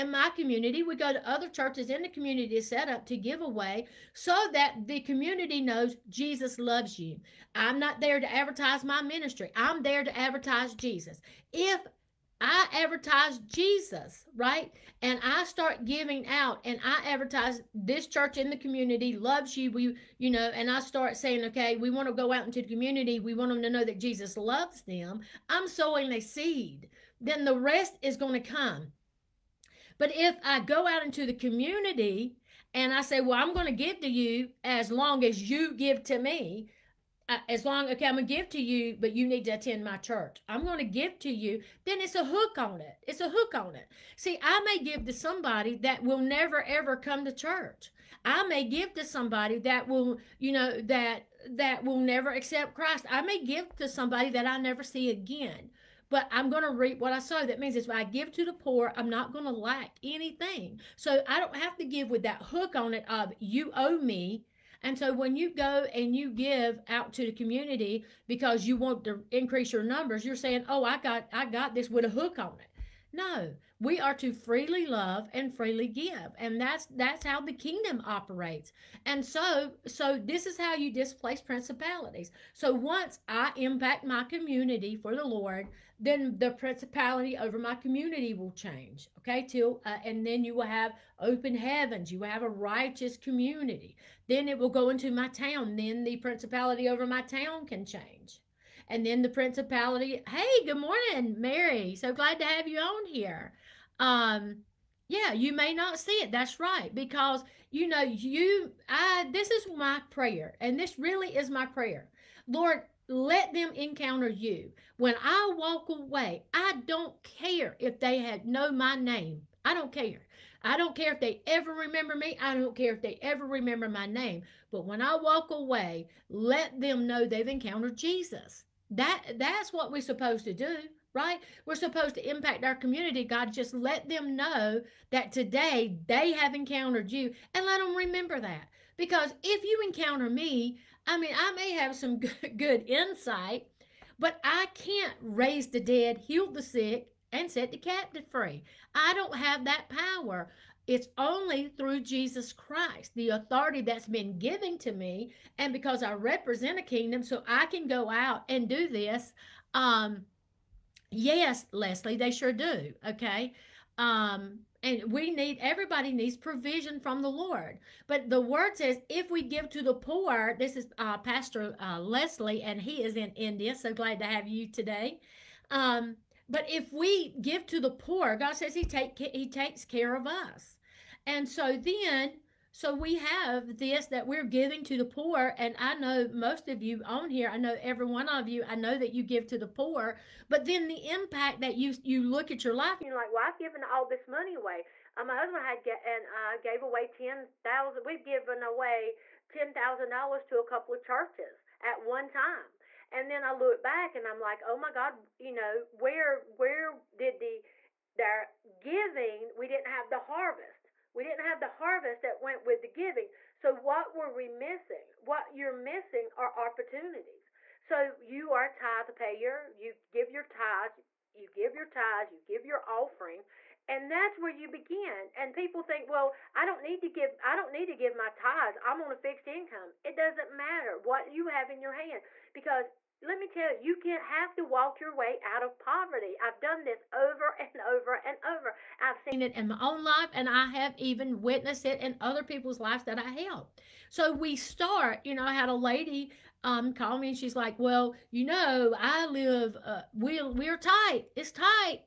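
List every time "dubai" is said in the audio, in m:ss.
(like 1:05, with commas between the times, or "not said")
not said.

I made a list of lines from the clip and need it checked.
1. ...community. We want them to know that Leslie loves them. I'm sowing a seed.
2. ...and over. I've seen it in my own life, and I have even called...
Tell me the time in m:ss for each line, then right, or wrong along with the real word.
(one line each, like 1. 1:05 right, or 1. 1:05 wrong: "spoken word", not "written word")
1. 0:22 wrong: "Jesus", not "Leslie"
2. 3:58 wrong: "witnessed", not "called".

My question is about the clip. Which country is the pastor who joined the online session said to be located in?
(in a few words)
India.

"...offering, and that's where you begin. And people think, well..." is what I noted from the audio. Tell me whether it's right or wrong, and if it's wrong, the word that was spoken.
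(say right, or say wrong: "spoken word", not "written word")
right.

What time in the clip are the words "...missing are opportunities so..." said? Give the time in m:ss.
3:35.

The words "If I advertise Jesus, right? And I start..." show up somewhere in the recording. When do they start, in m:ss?
0:11.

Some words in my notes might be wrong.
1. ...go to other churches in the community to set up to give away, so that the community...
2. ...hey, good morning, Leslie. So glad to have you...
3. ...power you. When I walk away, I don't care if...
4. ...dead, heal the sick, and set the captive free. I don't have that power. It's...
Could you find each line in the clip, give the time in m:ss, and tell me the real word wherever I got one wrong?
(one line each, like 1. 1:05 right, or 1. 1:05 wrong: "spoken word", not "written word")
1. 0:00 right
2. 1:40 wrong: "Mary", not "Leslie"
3. 1:53 wrong: "encounter", not "power"
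4. 2:25 right.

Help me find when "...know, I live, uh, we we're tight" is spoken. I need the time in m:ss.
4:08.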